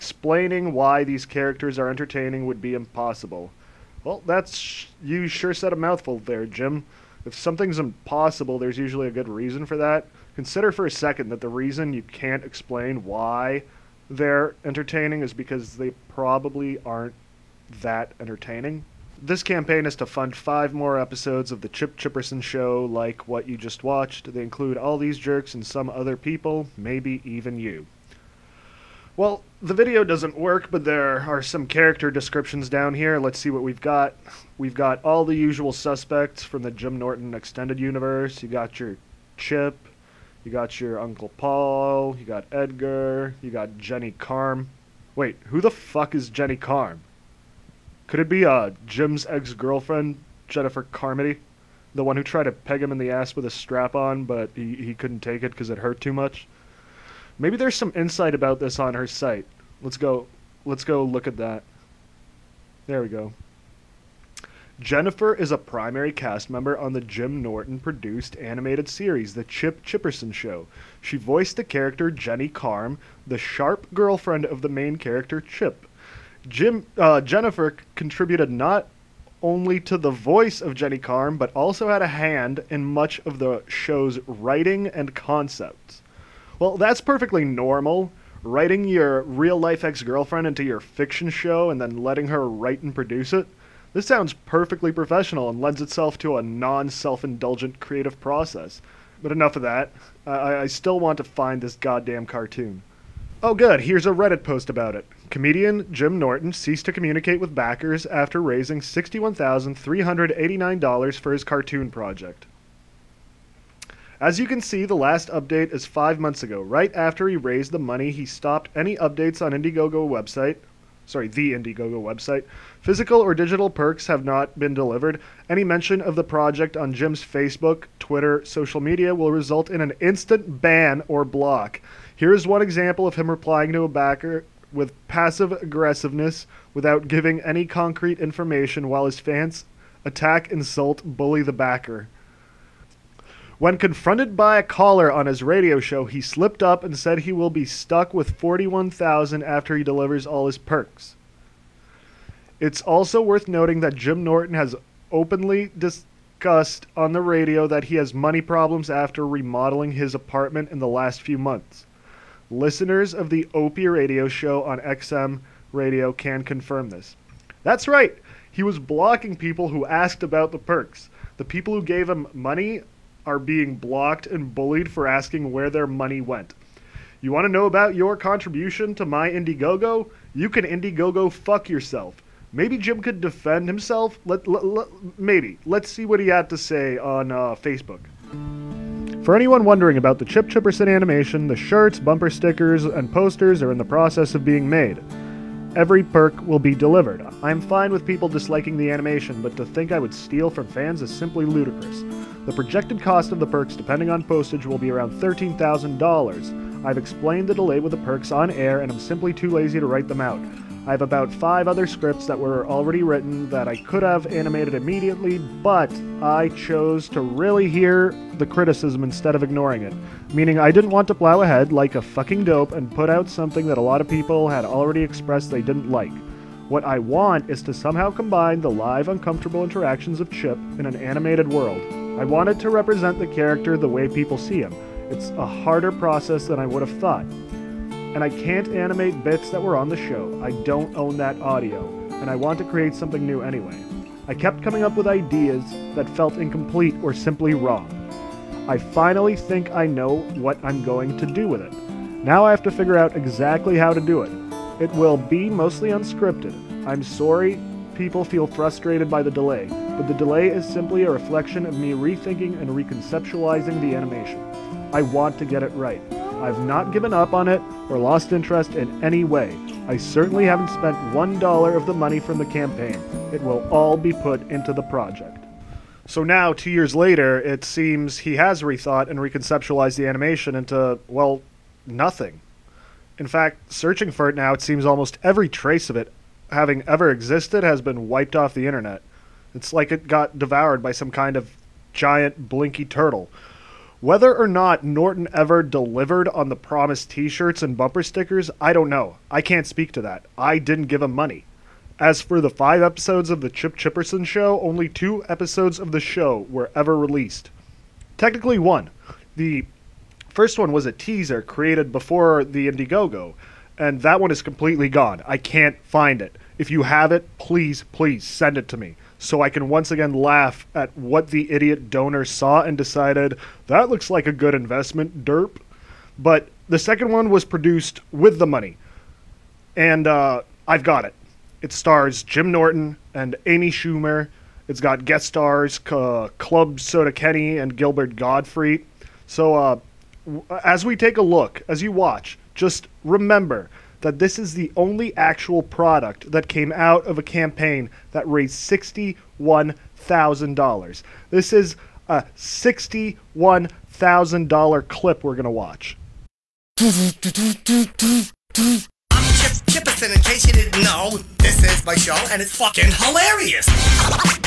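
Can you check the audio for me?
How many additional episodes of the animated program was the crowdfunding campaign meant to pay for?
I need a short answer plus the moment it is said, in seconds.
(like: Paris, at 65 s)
5, at 20 s.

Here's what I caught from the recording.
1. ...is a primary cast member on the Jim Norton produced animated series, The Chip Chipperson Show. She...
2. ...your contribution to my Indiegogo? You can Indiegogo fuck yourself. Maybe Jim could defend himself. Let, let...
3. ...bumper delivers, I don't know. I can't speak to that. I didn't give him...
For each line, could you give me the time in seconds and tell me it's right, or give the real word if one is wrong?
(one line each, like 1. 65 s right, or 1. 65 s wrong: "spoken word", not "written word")
1. 65 s right
2. 177 s right
3. 297 s wrong: "stickers", not "delivers".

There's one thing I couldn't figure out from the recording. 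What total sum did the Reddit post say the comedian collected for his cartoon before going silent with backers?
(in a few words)
$61,389.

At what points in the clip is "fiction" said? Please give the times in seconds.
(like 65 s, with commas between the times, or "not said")
90 s.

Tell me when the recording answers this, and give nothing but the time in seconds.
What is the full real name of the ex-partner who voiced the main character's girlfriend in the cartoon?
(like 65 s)
50 s.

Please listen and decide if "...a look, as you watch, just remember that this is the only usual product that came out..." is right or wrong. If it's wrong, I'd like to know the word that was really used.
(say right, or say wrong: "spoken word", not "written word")
wrong: "actual", not "usual".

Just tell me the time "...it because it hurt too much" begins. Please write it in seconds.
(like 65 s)
55 s.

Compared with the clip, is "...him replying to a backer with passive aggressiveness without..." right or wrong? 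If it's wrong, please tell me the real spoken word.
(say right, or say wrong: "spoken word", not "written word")
right.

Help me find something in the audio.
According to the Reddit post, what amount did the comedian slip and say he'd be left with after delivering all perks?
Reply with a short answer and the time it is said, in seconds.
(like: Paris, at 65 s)
41,000, at 148 s.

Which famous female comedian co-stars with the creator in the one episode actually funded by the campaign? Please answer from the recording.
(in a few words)
Amy Schumer.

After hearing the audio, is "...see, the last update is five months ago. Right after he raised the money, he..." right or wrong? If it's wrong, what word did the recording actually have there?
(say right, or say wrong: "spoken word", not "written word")
right.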